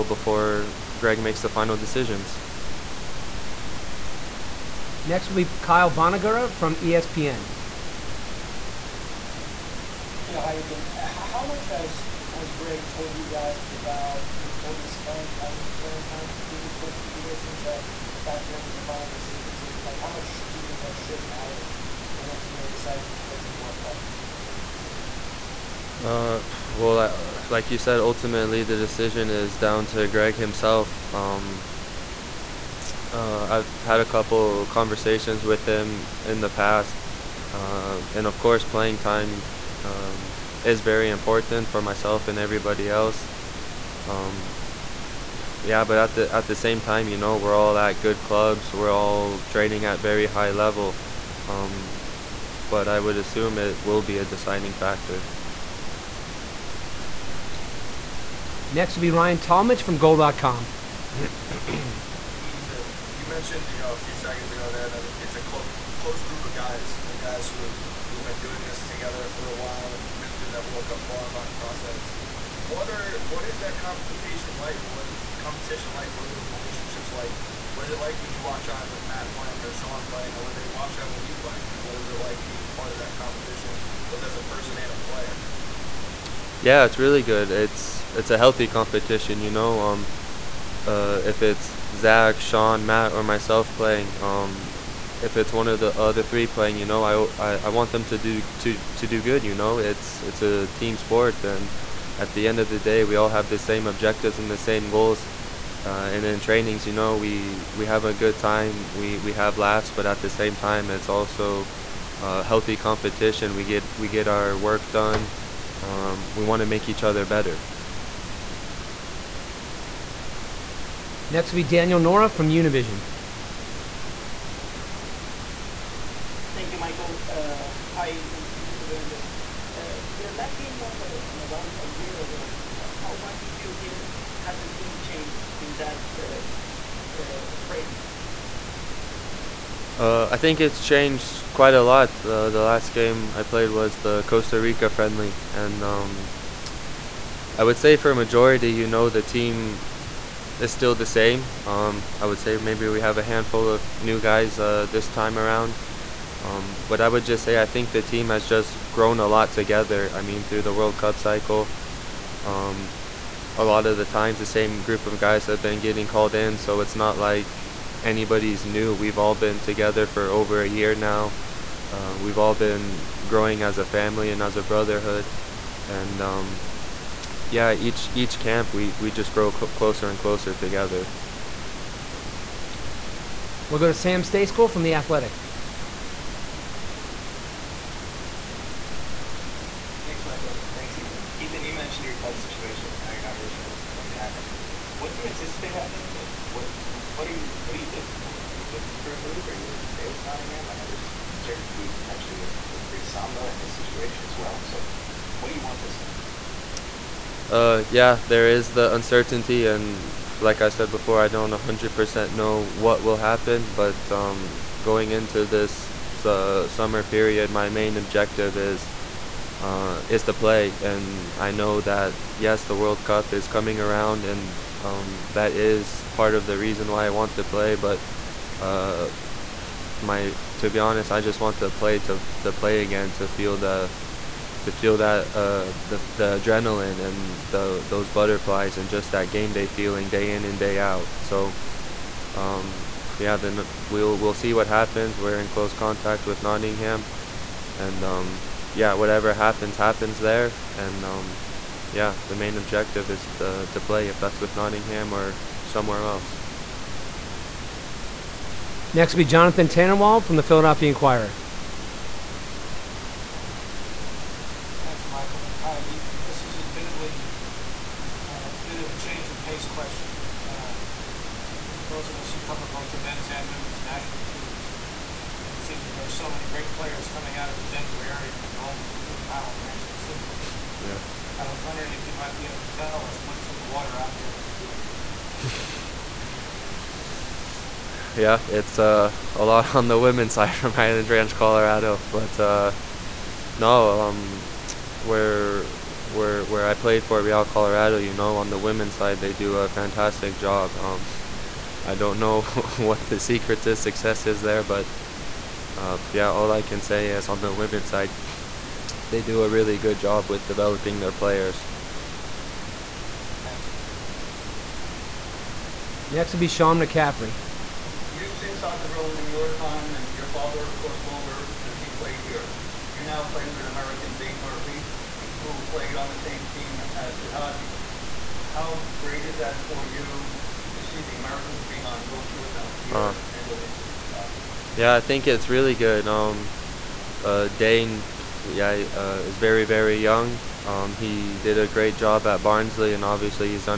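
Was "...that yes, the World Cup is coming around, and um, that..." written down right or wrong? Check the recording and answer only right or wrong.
right.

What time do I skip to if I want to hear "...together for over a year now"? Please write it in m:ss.
2:49.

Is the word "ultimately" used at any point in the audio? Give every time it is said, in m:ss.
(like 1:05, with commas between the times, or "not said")
0:22, 0:27.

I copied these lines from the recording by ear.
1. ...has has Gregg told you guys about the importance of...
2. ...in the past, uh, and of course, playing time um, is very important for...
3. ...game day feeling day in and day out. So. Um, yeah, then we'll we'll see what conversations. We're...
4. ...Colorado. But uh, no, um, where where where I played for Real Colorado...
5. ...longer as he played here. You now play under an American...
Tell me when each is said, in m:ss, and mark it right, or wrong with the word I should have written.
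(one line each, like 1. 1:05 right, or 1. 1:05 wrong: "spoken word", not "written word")
1. 0:11 right
2. 0:36 right
3. 3:59 wrong: "happens", not "conversations"
4. 4:51 right
5. 5:21 right.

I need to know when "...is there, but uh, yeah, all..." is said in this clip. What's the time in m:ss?
5:04.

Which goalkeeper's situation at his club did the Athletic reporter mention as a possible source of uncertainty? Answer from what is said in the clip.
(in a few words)
Brice Samba.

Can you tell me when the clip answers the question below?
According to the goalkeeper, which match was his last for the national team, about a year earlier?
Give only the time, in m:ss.
2:24.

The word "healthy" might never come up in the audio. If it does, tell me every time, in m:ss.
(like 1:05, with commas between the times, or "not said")
1:28, 1:52.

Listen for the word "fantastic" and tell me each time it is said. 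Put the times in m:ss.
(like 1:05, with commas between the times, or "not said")
4:59.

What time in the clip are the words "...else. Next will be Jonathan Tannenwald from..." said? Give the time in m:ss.
4:16.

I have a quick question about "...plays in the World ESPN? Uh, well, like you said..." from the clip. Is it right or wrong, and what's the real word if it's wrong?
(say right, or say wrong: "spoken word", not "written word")
wrong: "Cup", not "ESPN".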